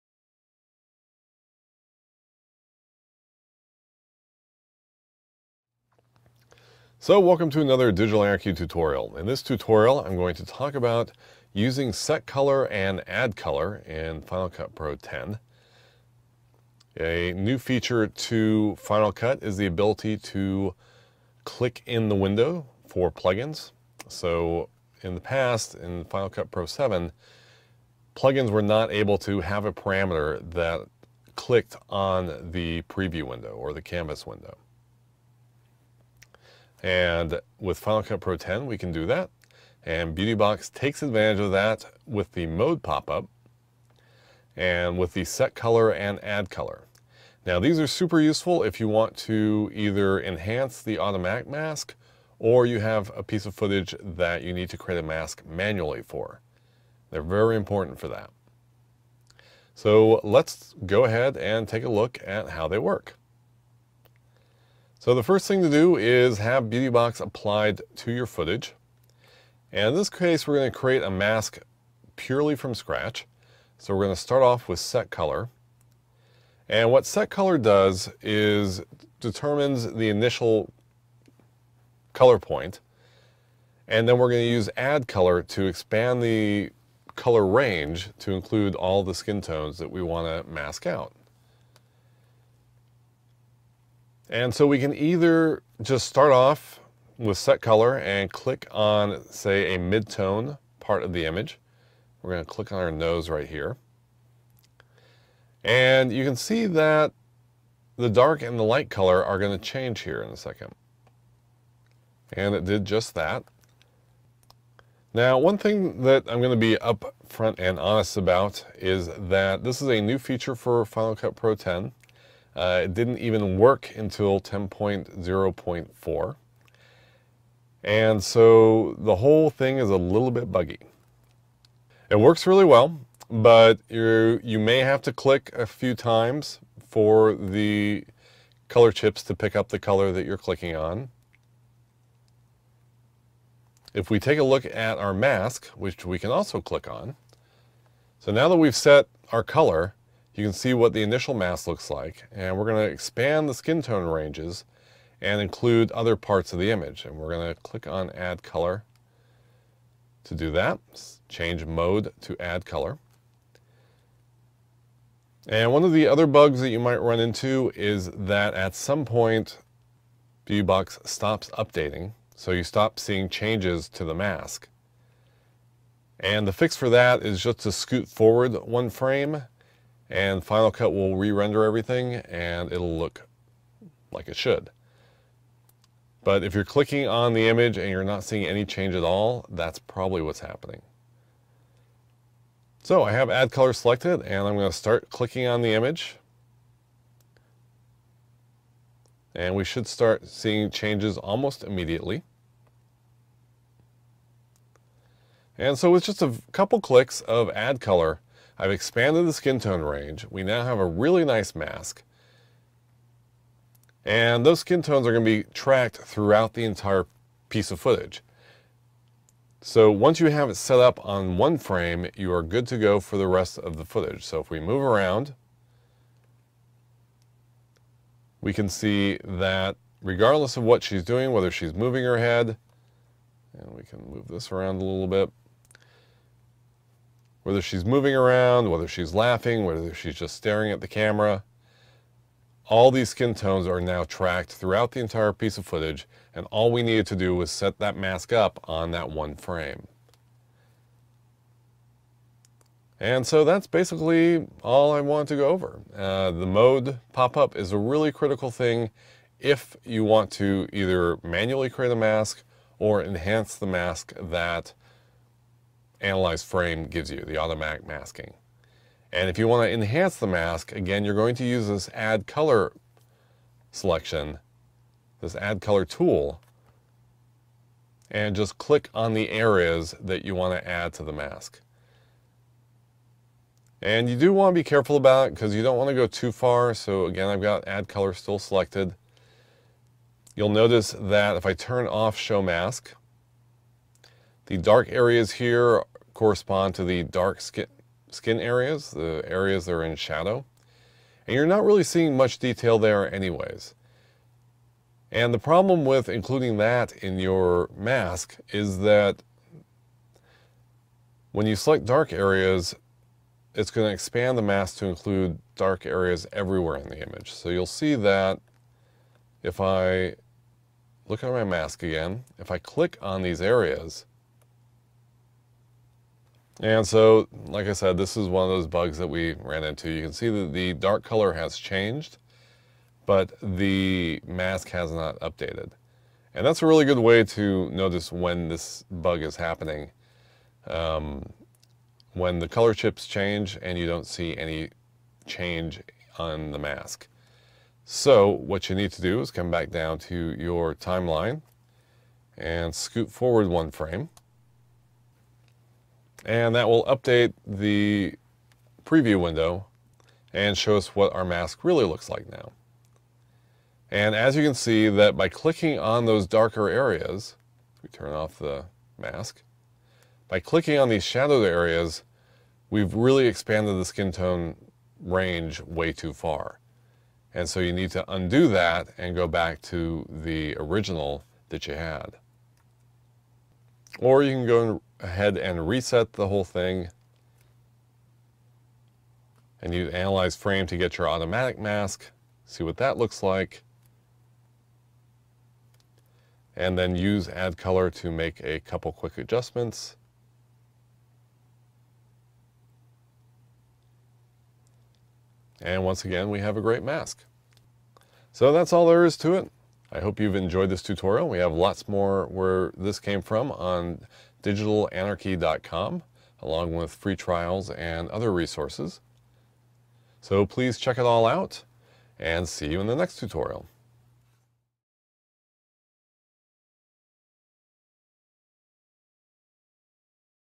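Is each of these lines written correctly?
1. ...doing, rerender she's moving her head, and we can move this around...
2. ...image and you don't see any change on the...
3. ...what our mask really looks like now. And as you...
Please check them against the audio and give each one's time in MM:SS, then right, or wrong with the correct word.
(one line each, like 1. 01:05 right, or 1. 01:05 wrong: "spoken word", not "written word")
1. 03:51 wrong: "whether", not "rerender"
2. 05:43 wrong: "change", not "image"
3. 06:00 right.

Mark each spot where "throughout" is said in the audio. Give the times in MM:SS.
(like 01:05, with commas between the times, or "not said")
03:35, 04:04.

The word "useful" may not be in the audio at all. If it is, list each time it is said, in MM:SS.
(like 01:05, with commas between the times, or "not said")
00:48.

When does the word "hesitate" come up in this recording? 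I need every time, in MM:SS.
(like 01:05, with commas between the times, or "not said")
not said.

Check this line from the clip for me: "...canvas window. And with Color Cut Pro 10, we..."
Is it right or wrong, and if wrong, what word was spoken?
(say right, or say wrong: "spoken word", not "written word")
wrong: "Final", not "Color".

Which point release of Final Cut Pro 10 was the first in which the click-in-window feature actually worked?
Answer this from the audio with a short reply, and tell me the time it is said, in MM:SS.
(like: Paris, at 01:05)
10.0.4, at 02:04.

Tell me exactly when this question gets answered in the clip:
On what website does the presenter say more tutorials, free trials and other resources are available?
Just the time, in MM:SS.
06:54.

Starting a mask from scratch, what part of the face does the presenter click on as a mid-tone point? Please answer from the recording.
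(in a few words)
Nose.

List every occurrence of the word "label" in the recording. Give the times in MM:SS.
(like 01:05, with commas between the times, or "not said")
not said.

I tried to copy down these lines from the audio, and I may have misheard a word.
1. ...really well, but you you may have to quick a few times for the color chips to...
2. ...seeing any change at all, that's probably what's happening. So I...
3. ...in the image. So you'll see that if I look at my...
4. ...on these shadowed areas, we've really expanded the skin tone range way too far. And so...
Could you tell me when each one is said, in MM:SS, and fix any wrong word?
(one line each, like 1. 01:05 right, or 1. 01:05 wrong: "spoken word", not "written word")
1. 02:12 wrong: "click", not "quick"
2. 03:08 right
3. 05:16 right
4. 06:10 right.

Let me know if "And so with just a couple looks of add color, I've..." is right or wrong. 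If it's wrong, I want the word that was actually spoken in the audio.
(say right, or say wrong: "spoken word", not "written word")
wrong: "clicks", not "looks".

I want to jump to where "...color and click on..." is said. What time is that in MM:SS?
01:37.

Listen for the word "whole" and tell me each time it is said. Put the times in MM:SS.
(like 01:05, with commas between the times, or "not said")
02:09, 06:26.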